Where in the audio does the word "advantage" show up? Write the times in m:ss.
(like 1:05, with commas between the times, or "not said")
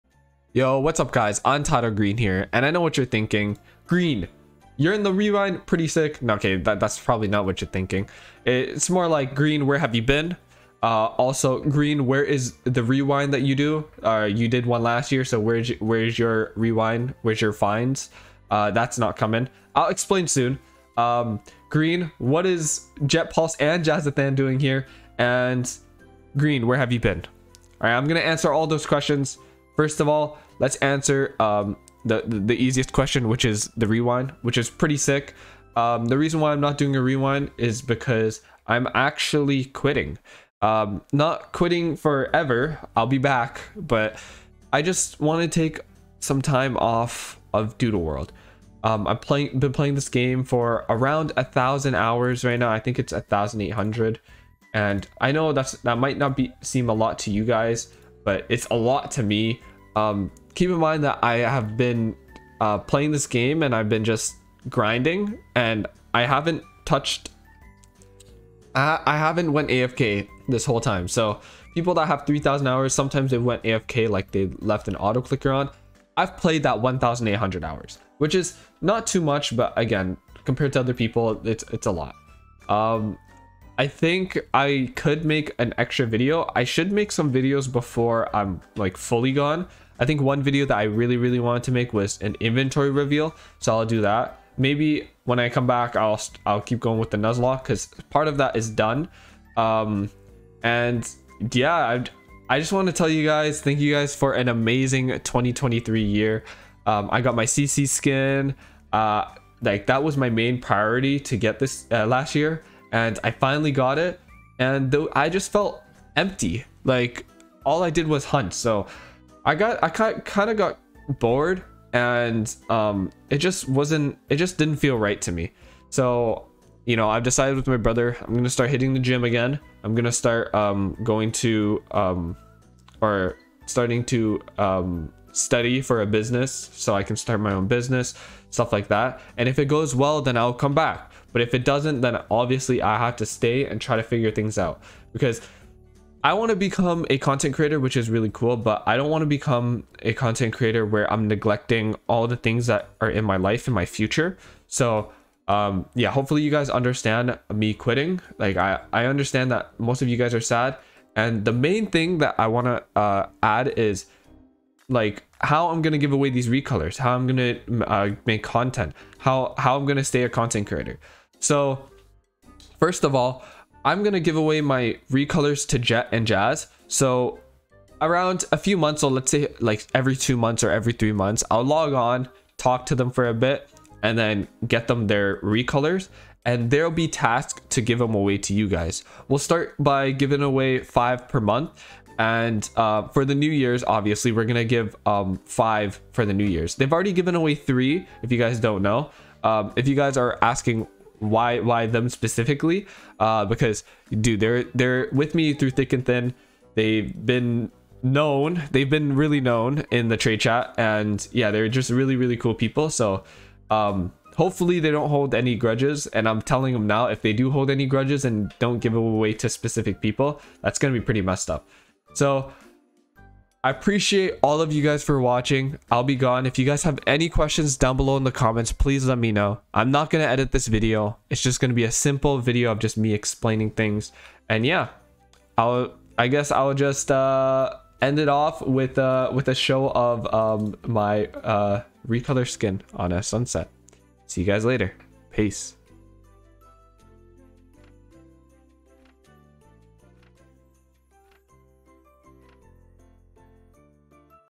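not said.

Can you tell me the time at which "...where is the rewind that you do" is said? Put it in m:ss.
0:12.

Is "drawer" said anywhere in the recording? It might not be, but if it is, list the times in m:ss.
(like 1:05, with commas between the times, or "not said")
not said.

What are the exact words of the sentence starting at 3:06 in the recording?
And there'll be tasks to give them away to you guys.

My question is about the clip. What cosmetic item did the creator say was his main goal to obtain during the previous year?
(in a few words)
CC skin.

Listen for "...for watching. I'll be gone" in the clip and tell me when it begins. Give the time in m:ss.
3:45.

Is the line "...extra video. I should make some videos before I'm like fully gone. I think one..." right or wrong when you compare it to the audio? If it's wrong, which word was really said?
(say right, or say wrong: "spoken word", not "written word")
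right.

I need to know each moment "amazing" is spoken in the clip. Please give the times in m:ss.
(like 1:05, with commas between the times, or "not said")
1:44.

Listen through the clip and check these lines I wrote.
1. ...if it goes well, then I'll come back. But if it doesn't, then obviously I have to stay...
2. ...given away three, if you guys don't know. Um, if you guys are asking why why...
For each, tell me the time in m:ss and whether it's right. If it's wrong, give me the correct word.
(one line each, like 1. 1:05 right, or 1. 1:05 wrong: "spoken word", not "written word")
1. 2:19 right
2. 3:17 right.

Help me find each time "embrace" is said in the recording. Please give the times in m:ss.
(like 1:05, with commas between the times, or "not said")
not said.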